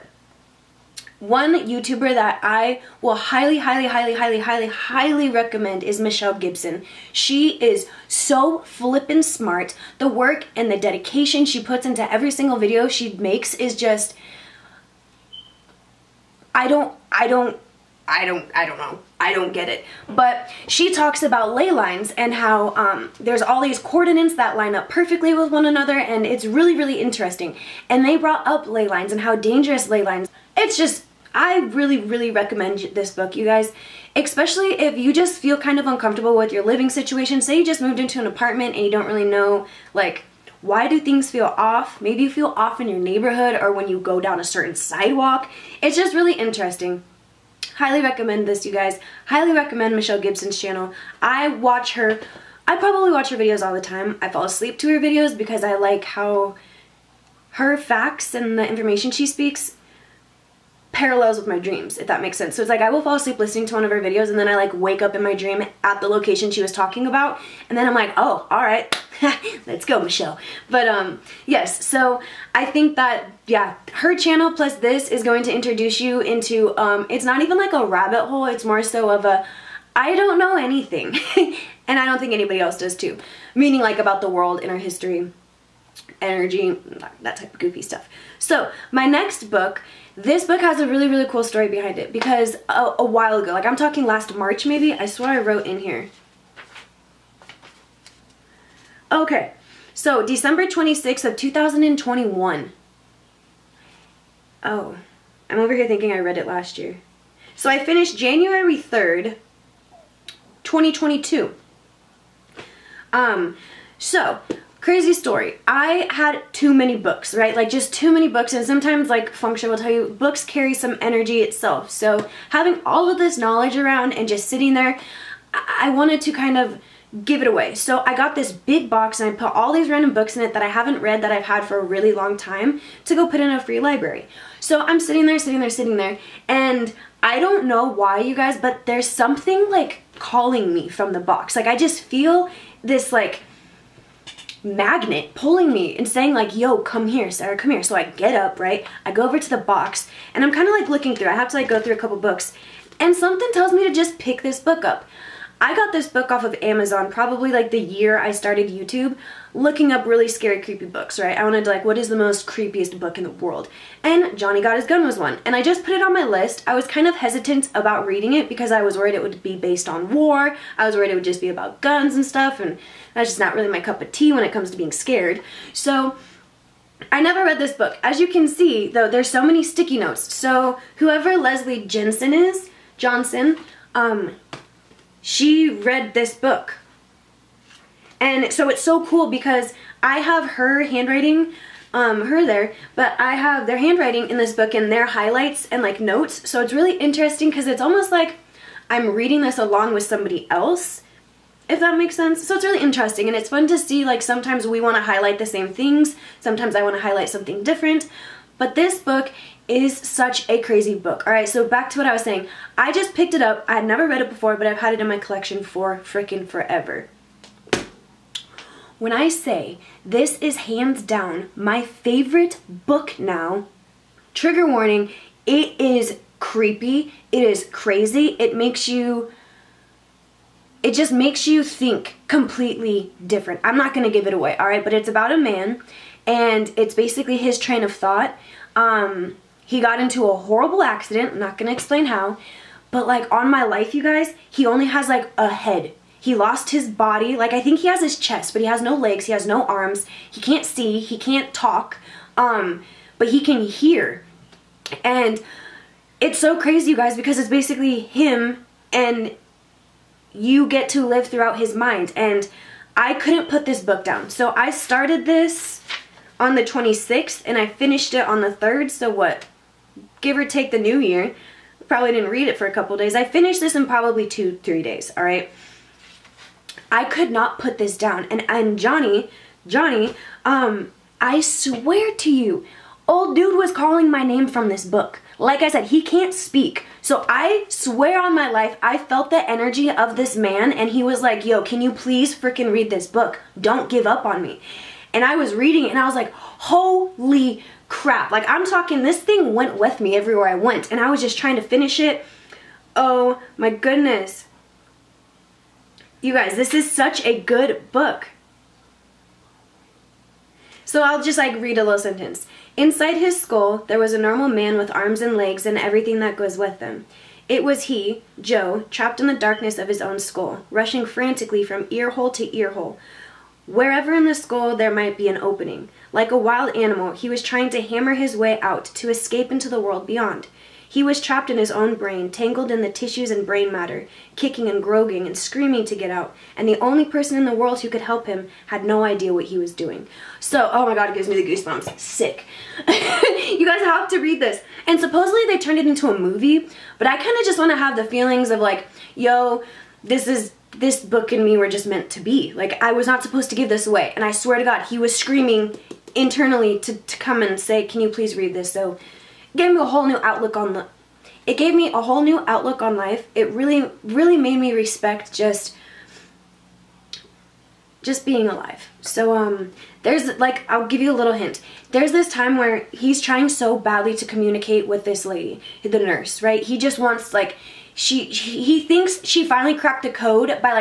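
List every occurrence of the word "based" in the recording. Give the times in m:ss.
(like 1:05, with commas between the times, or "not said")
2:49.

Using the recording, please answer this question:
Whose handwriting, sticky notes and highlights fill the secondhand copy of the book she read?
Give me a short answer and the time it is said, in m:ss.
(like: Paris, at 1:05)
Leslie Jensen, at 3:01.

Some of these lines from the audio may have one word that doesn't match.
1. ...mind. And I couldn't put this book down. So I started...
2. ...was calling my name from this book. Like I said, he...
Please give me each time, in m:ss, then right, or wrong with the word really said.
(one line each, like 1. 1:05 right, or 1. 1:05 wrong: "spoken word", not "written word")
1. 4:21 right
2. 4:43 right.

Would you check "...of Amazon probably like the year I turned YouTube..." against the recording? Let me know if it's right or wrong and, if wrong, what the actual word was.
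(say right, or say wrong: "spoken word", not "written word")
wrong: "started", not "turned".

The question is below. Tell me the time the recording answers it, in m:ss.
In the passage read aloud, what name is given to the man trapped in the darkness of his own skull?
5:18.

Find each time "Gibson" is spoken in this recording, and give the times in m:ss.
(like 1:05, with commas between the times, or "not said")
0:06, 0:50.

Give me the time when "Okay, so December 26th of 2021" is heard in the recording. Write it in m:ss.
1:39.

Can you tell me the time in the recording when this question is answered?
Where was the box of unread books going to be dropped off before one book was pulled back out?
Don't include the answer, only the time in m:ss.
2:13.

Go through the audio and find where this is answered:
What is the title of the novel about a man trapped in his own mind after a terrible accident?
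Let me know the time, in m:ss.
2:44.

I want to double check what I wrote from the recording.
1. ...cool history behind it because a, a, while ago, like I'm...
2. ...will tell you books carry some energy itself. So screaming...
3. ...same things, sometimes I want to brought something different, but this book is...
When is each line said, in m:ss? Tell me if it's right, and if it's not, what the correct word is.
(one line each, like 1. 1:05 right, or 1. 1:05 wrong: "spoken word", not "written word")
1. 1:31 wrong: "story", not "history"
2. 1:59 wrong: "having", not "screaming"
3. 3:25 wrong: "highlight", not "brought".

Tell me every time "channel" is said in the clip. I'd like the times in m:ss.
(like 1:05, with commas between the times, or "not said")
0:50, 1:14.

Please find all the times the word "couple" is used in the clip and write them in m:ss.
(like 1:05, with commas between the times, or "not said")
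2:31, 4:32.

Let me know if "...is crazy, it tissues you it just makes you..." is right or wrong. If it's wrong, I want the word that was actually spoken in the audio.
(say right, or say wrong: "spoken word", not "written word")
wrong: "makes", not "tissues".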